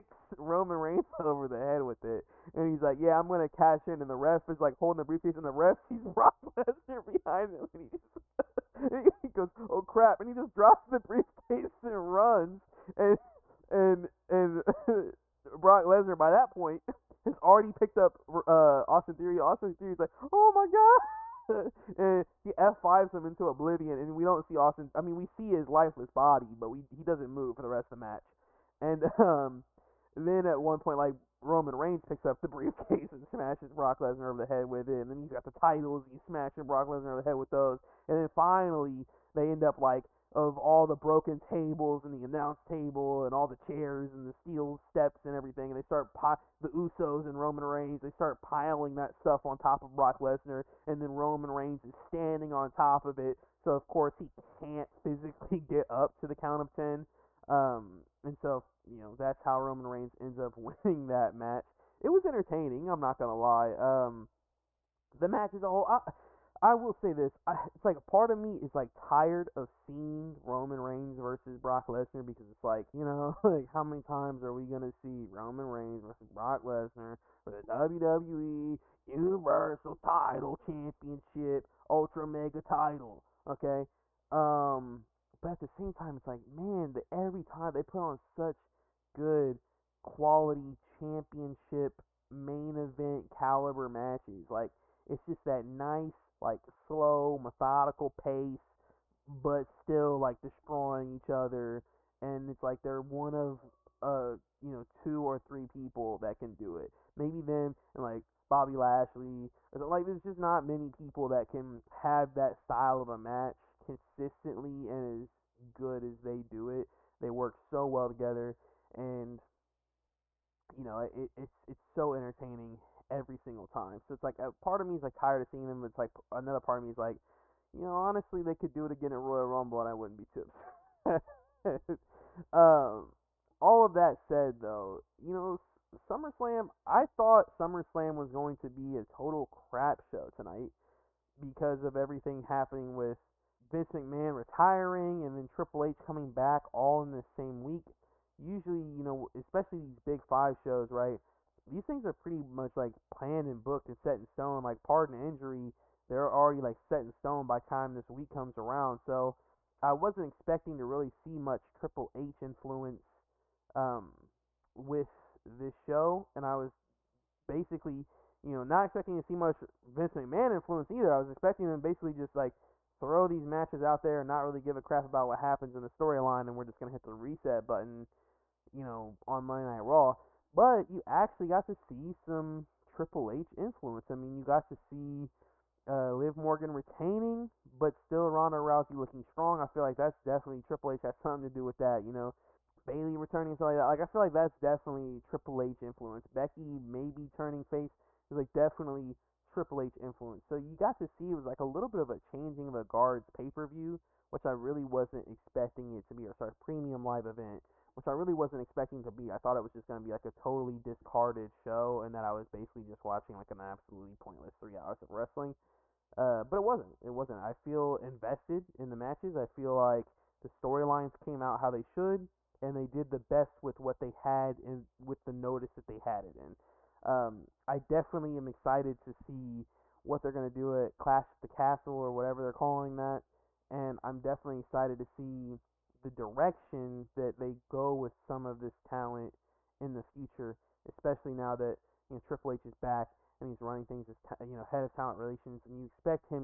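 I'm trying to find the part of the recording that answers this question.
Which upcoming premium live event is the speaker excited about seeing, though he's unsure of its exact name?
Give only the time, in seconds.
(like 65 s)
230 s.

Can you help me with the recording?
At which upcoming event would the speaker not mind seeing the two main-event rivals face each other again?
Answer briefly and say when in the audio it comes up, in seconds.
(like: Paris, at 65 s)
Royal Rumble, at 129 s.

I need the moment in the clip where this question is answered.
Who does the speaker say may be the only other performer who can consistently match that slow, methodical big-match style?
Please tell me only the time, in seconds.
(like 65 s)
108 s.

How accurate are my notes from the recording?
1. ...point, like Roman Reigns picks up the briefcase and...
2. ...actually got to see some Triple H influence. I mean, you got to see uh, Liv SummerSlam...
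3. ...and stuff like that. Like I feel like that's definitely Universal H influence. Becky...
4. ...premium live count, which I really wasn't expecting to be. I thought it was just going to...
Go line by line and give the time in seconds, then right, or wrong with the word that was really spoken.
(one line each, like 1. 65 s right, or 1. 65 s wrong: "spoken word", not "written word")
1. 30 s right
2. 181 s wrong: "Morgan", not "SummerSlam"
3. 193 s wrong: "Triple", not "Universal"
4. 206 s wrong: "event", not "count".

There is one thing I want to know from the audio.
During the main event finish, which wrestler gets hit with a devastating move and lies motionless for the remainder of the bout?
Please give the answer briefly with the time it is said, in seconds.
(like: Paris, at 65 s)
Austin Theory, at 19 s.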